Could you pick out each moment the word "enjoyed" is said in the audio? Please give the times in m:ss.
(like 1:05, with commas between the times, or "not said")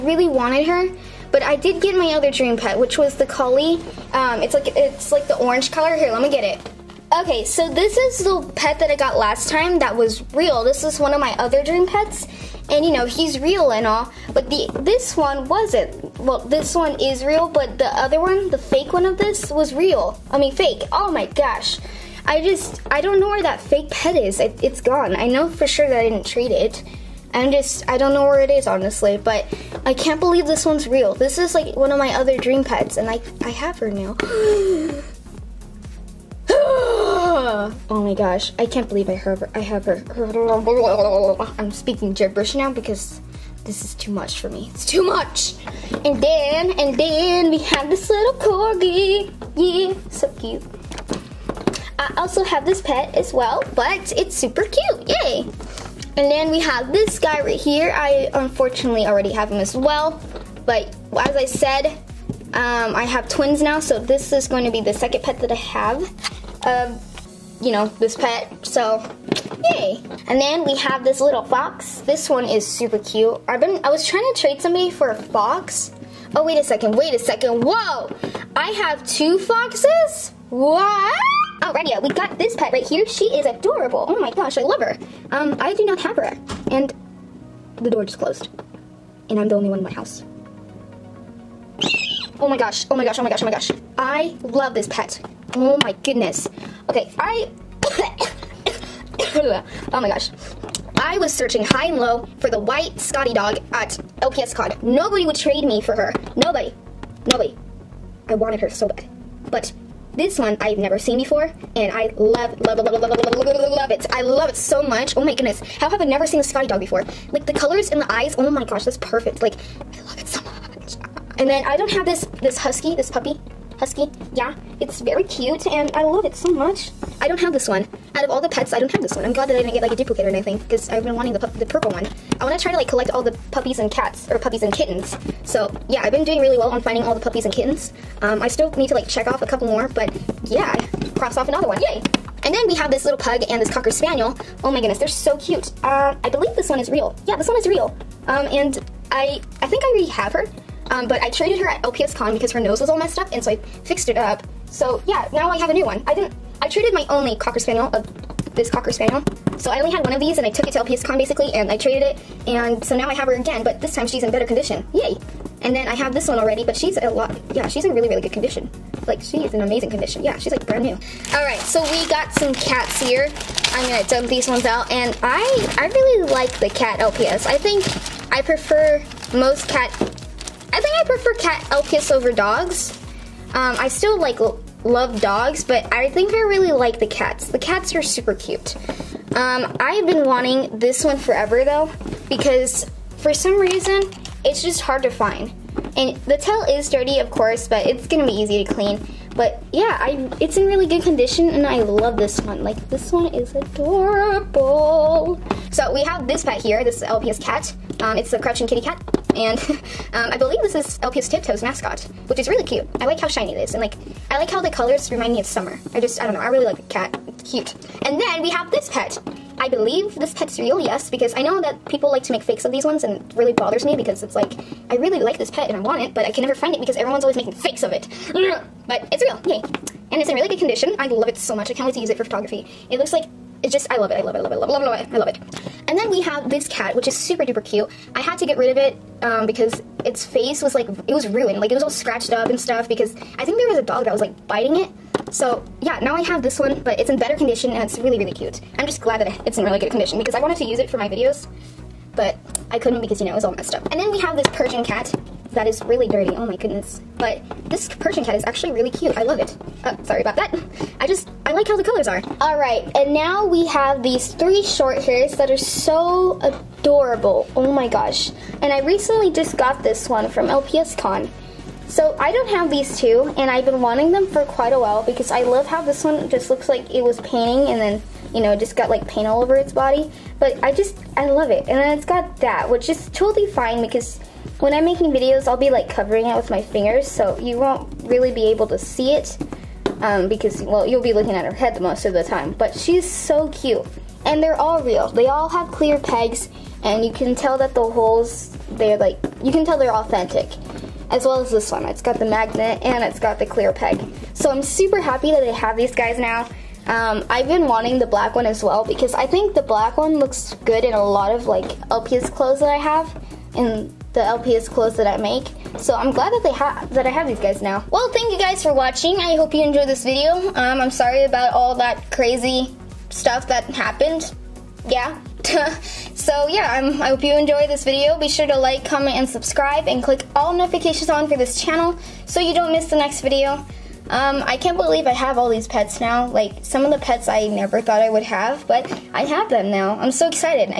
5:19, 5:27.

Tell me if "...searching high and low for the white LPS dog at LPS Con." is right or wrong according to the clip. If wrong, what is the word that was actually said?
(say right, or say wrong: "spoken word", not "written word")
wrong: "Scotty", not "LPS".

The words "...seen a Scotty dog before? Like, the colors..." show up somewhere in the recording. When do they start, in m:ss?
1:56.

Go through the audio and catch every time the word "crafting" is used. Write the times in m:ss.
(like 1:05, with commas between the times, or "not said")
not said.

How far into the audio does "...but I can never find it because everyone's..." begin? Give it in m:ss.
3:46.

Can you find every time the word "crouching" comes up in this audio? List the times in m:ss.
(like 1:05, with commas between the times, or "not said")
3:28.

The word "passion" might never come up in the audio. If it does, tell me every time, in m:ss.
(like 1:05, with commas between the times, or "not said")
not said.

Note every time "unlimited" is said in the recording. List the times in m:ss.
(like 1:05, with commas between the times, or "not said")
not said.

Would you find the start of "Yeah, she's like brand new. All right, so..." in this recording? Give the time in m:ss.
2:50.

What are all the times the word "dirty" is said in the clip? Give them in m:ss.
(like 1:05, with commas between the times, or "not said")
3:16, 4:16.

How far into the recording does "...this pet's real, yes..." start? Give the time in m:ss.
3:40.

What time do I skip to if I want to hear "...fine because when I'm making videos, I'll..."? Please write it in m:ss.
4:43.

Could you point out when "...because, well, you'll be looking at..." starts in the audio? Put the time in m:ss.
4:50.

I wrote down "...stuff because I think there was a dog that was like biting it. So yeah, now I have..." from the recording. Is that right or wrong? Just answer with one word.
right.